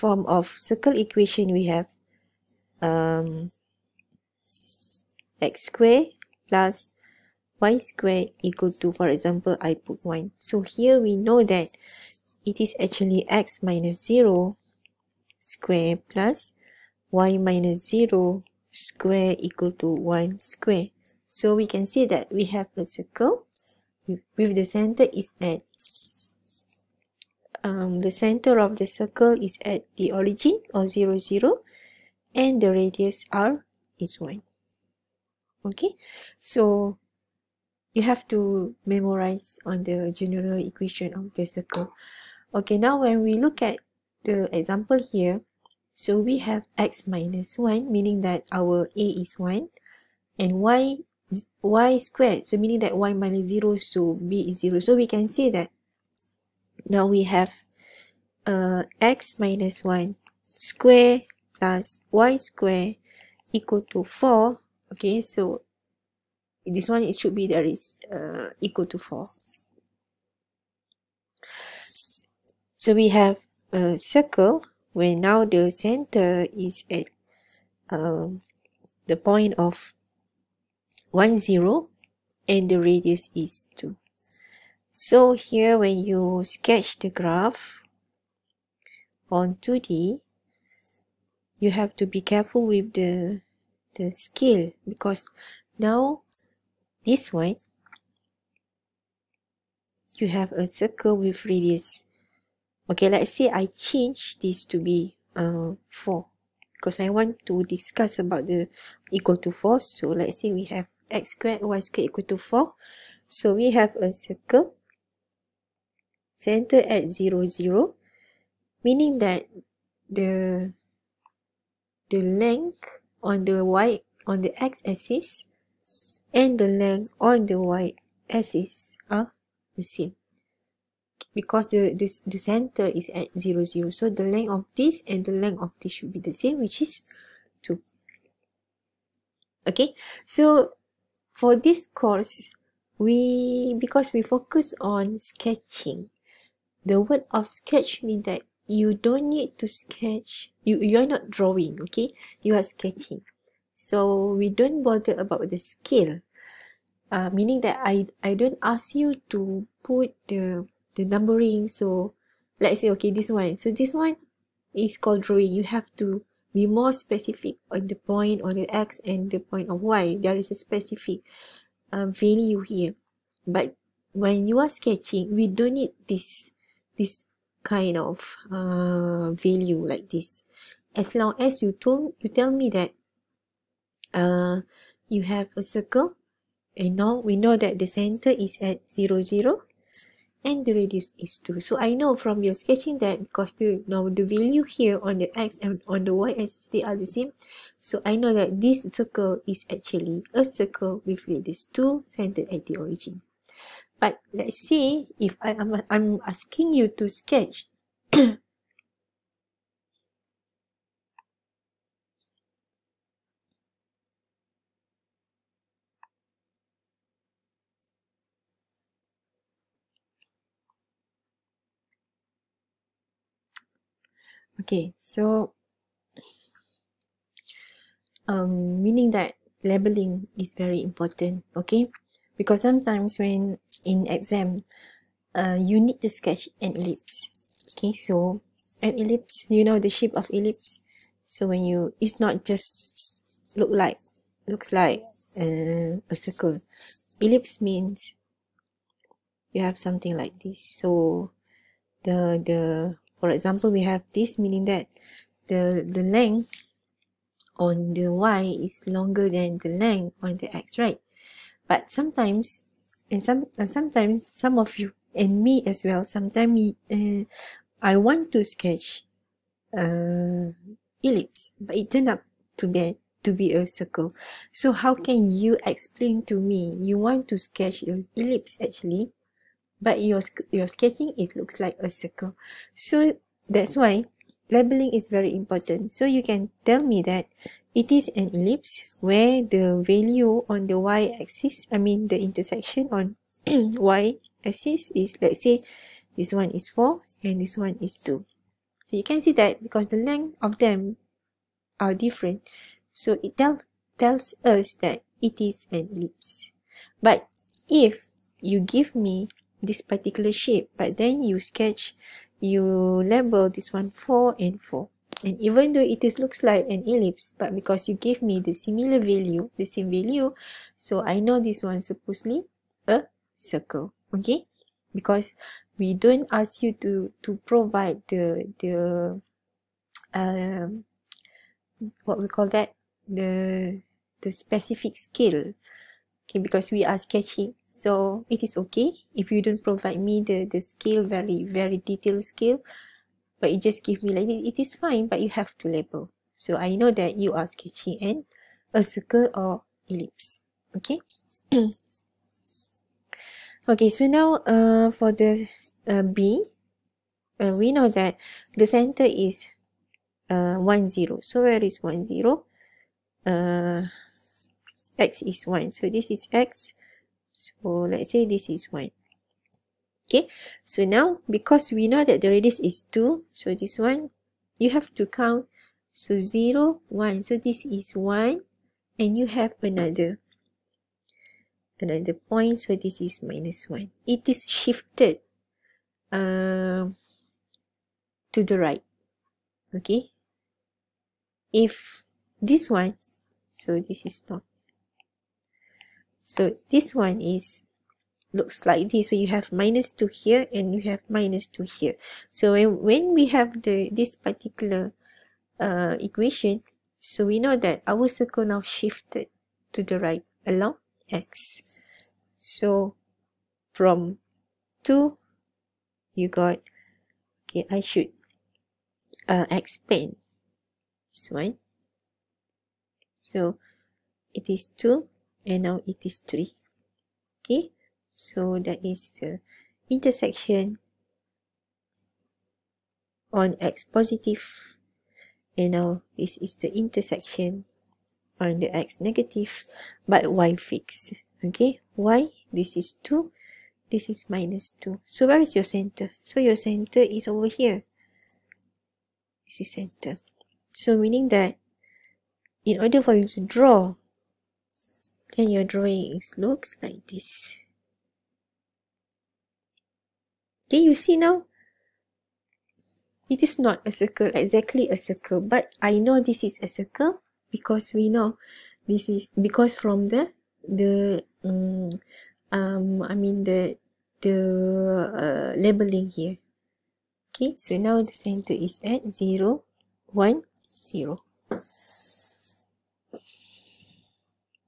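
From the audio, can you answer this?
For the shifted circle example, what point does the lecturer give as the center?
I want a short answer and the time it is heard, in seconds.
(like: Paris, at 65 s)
(1, 0), at 79 s.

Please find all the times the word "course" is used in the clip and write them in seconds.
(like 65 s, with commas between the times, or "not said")
141 s.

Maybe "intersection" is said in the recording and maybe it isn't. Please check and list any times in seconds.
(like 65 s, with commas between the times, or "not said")
292 s, 429 s, 436 s.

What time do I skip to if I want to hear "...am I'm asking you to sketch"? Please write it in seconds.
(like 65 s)
205 s.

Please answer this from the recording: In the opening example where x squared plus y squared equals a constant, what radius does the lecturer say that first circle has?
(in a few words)
1.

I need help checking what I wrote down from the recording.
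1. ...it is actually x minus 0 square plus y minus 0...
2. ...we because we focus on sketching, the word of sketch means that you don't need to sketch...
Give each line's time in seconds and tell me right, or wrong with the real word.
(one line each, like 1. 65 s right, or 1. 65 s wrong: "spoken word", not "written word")
1. 12 s right
2. 142 s right.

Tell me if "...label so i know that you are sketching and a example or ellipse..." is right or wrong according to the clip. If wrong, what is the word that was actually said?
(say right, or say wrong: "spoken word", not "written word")
wrong: "circle", not "example".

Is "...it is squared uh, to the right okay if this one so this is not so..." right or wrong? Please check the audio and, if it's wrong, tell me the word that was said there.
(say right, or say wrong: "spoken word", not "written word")
wrong: "shifted", not "squared".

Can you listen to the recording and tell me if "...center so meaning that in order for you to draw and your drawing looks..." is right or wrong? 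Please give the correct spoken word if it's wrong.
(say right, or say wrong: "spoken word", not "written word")
right.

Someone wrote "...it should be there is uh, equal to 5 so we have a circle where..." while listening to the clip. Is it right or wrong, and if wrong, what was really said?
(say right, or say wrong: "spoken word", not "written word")
wrong: "4", not "5".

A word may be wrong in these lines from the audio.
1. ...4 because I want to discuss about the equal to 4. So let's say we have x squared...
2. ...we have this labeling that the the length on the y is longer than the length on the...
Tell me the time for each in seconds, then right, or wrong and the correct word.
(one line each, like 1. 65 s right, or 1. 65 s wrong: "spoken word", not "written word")
1. 105 s right
2. 253 s wrong: "meaning", not "labeling".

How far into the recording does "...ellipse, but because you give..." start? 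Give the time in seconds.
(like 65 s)
316 s.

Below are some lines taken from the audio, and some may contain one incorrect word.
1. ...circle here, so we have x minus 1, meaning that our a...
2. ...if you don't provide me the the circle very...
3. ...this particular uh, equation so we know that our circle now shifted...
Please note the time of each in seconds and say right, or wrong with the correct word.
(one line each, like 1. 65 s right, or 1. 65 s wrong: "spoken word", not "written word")
1. 44 s wrong: "example", not "circle"
2. 339 s wrong: "scale", not "circle"
3. 403 s right.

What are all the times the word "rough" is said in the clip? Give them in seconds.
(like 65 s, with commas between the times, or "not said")
not said.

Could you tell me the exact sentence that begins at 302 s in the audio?
So it tell, tells us that it is an ellipse.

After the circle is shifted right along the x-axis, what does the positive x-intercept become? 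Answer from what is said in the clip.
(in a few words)
3.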